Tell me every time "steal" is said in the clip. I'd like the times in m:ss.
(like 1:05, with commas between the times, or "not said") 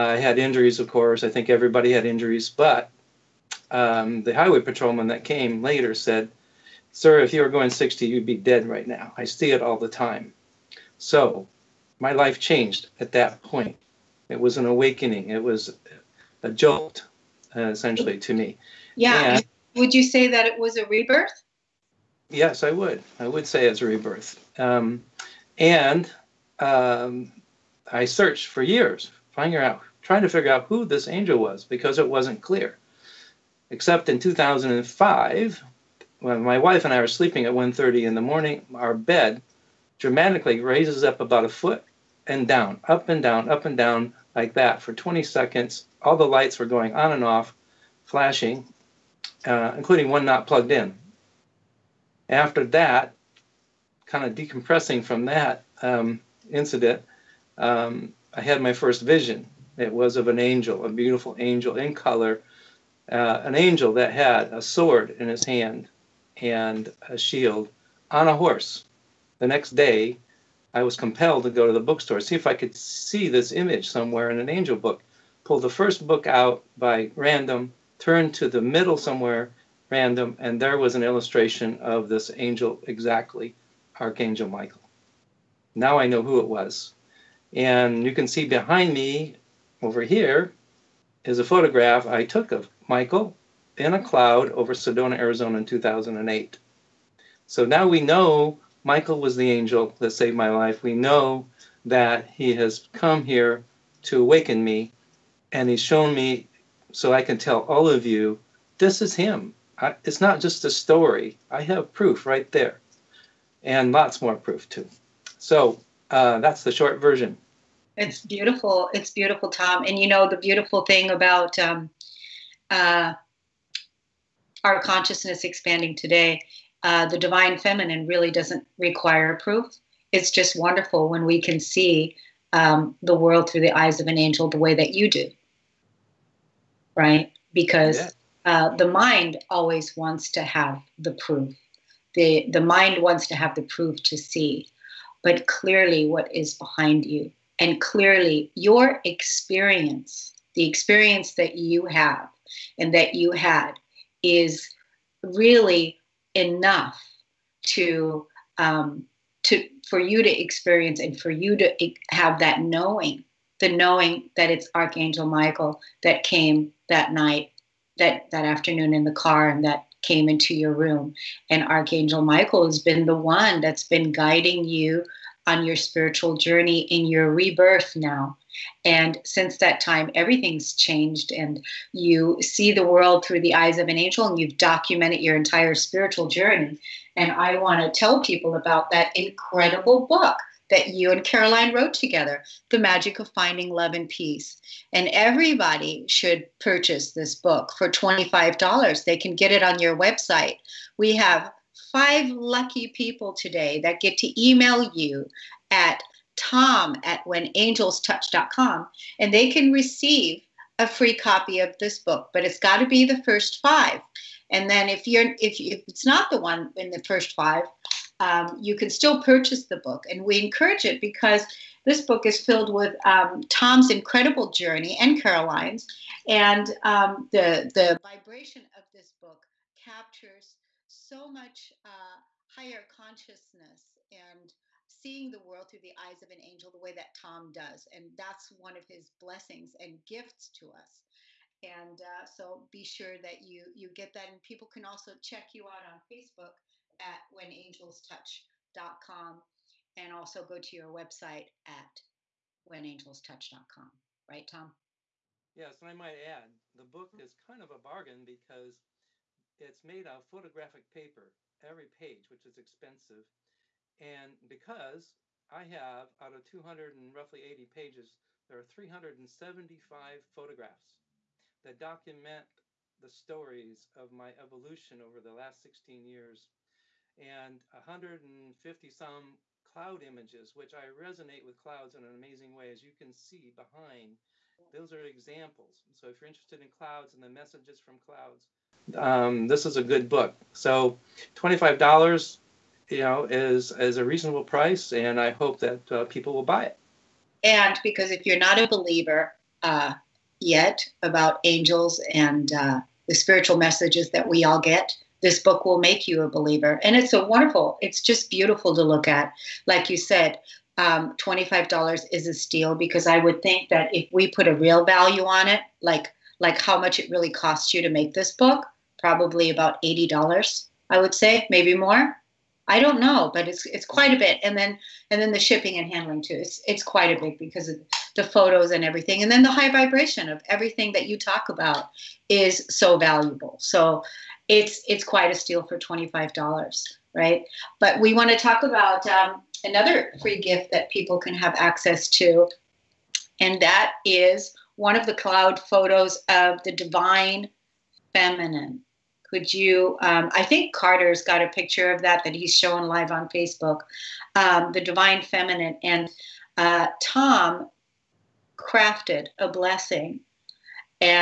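5:12, 5:35.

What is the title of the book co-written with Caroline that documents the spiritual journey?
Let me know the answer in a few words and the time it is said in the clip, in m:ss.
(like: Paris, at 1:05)
The Magic of Finding Love and Peace, at 3:12.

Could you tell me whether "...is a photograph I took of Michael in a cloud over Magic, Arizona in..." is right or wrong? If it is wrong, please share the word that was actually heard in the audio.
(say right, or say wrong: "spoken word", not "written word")
wrong: "Sedona", not "Magic".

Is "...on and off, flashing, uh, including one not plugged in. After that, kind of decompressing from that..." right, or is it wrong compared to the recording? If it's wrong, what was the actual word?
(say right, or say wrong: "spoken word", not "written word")
right.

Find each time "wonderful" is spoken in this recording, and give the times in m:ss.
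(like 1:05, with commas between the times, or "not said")
2:10, 5:07.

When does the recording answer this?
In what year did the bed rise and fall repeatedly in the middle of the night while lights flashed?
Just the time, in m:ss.
0:34.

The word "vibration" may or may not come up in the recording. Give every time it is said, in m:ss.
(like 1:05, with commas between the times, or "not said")
3:48, 5:29.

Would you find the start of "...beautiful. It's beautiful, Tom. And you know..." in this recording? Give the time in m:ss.
1:58.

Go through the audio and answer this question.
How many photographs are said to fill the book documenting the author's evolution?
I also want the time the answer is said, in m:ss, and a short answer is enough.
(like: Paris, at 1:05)
375, at 4:28.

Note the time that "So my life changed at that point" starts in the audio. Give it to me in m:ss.
0:10.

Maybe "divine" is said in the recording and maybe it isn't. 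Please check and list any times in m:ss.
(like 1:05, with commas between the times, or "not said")
2:07, 5:46, 5:54.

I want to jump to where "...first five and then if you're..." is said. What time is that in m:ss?
3:33.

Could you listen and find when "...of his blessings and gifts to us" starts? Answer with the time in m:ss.
3:58.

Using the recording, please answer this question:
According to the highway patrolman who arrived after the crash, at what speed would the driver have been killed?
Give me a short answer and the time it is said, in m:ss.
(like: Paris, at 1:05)
60, at 0:07.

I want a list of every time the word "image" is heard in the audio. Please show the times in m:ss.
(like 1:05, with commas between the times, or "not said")
1:13, 4:40.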